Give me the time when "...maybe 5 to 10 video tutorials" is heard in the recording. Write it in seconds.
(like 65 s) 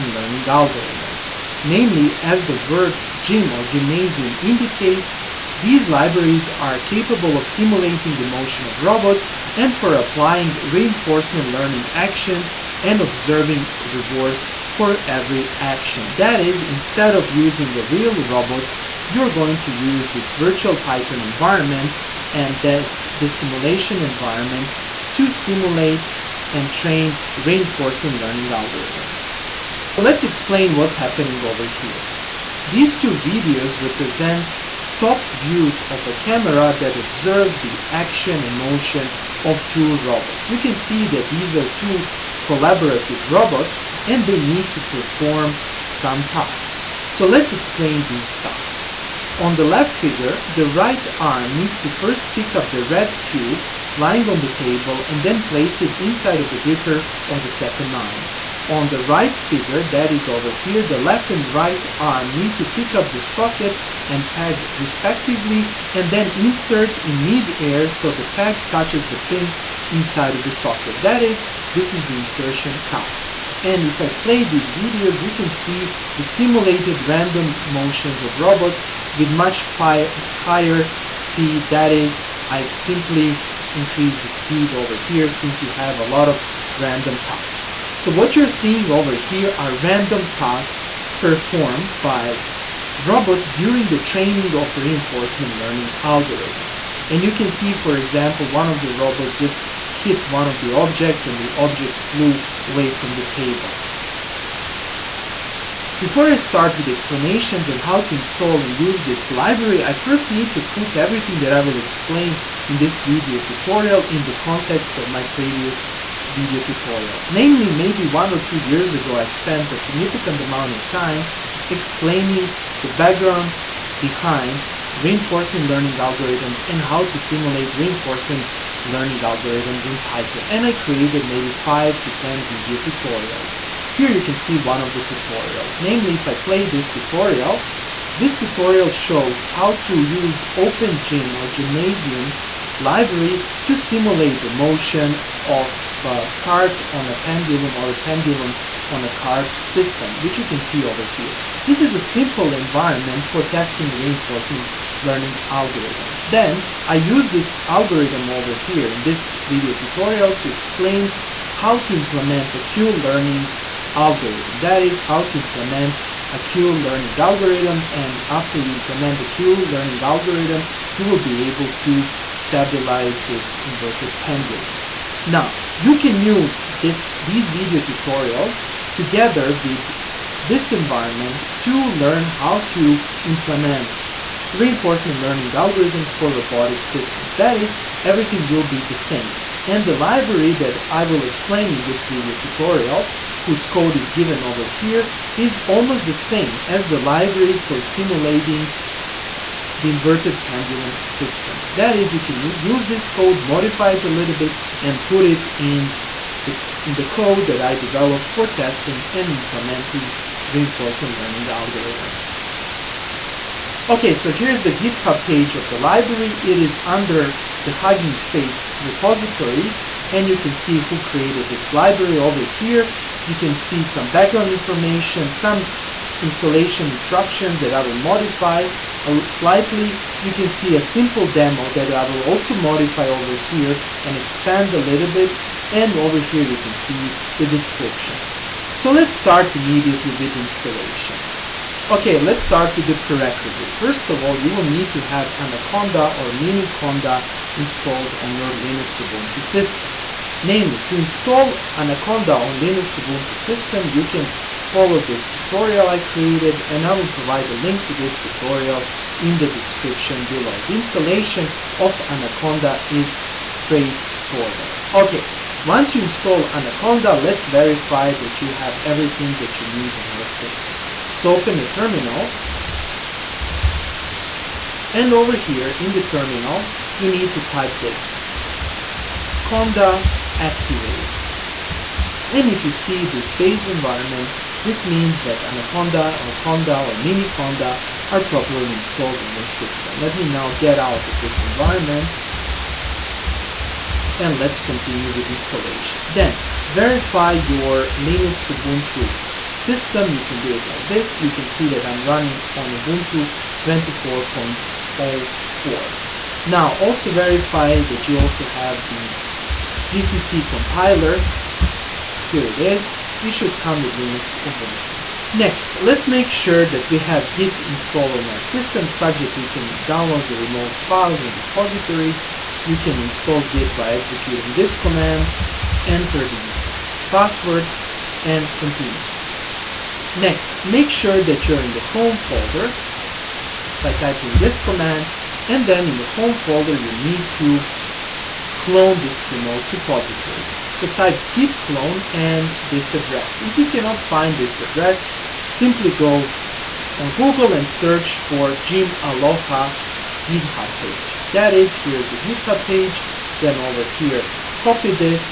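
131 s.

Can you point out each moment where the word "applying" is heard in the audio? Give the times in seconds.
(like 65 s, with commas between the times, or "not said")
10 s.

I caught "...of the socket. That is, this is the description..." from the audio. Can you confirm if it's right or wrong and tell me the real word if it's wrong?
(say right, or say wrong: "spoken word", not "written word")
wrong: "insertion", not "description".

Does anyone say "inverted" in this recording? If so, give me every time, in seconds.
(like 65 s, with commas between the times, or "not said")
173 s, 199 s.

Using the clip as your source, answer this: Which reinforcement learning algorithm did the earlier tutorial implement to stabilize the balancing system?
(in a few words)
Q-learning.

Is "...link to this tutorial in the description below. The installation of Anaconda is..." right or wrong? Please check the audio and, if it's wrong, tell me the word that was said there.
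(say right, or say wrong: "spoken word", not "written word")
right.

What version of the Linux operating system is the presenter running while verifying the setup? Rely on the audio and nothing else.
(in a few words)
Ubuntu 24.04.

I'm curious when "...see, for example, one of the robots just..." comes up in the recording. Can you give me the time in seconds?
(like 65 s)
97 s.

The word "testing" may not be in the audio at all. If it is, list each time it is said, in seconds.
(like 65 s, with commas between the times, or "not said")
153 s, 208 s.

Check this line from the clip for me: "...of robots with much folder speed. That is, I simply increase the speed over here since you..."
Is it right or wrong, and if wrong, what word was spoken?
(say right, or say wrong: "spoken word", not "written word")
wrong: "higher", not "folder".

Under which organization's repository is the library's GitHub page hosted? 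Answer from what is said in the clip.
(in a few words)
Hugging Face.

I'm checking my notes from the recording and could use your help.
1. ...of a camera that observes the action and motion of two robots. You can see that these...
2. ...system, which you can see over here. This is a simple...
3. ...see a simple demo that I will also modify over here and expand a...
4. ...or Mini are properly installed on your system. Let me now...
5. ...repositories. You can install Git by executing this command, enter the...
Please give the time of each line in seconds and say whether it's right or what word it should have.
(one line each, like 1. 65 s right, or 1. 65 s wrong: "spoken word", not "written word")
1. 35 s right
2. 149 s right
3. 230 s right
4. 286 s right
5. 321 s right.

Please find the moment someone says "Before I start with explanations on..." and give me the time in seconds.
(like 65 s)
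105 s.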